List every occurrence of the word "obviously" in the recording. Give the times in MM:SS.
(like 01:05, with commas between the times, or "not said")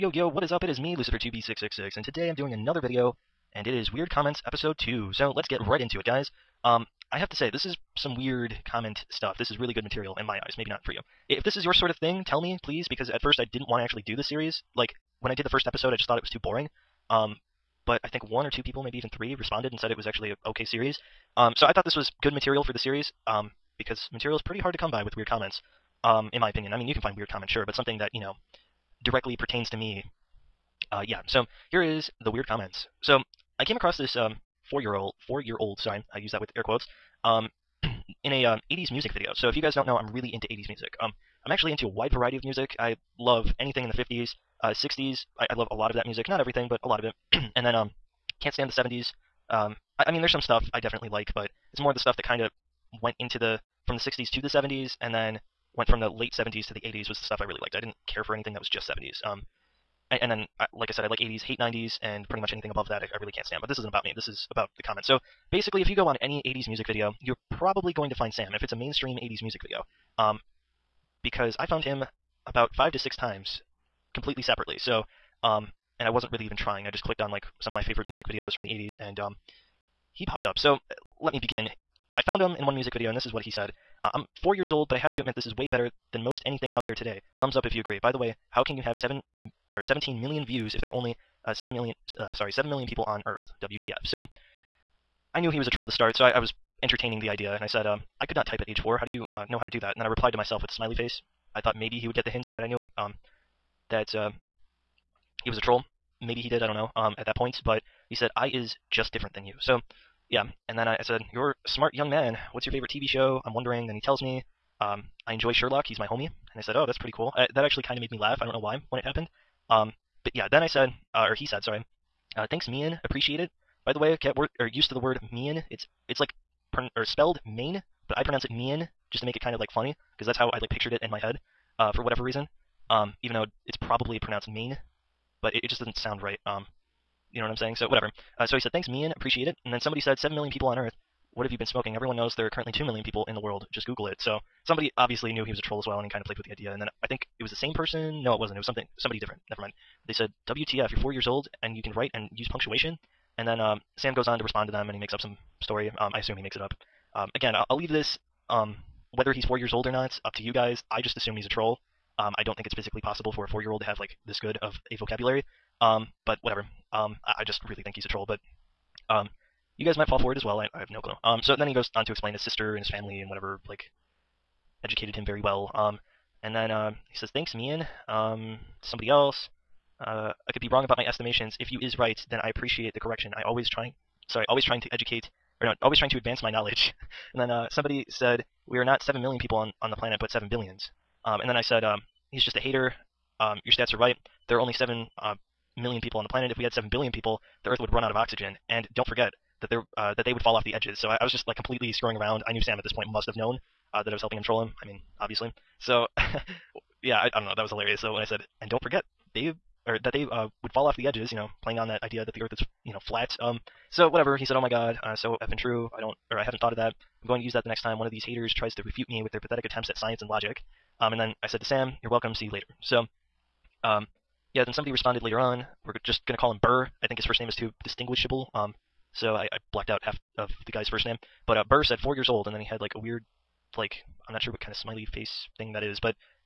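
02:24, 03:25.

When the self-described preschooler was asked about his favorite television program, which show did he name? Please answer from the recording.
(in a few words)
Sherlock.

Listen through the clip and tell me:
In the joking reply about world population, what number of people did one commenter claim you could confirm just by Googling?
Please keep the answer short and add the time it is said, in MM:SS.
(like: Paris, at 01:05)
2 million, at 02:22.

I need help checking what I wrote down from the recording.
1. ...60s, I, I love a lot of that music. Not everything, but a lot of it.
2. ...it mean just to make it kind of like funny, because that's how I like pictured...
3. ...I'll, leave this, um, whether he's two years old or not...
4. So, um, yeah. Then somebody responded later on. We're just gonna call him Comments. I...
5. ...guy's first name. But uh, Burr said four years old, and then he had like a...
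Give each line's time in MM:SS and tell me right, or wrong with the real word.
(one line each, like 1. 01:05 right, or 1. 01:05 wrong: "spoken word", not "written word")
1. 00:44 right
2. 02:08 right
3. 02:37 wrong: "four", not "two"
4. 03:42 wrong: "Burr", not "Comments"
5. 03:50 right.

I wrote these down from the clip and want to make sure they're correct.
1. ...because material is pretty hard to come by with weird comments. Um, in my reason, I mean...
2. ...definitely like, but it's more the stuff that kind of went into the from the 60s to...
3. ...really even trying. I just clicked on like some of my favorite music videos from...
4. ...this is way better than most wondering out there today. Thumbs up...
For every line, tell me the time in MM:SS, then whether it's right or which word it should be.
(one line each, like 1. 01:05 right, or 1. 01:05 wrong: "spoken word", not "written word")
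1. 00:23 wrong: "opinion", not "reason"
2. 00:50 right
3. 01:16 right
4. 01:25 wrong: "anything", not "wondering".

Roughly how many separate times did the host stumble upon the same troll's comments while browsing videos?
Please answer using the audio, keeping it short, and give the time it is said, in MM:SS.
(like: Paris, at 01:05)
5 to 6, at 01:12.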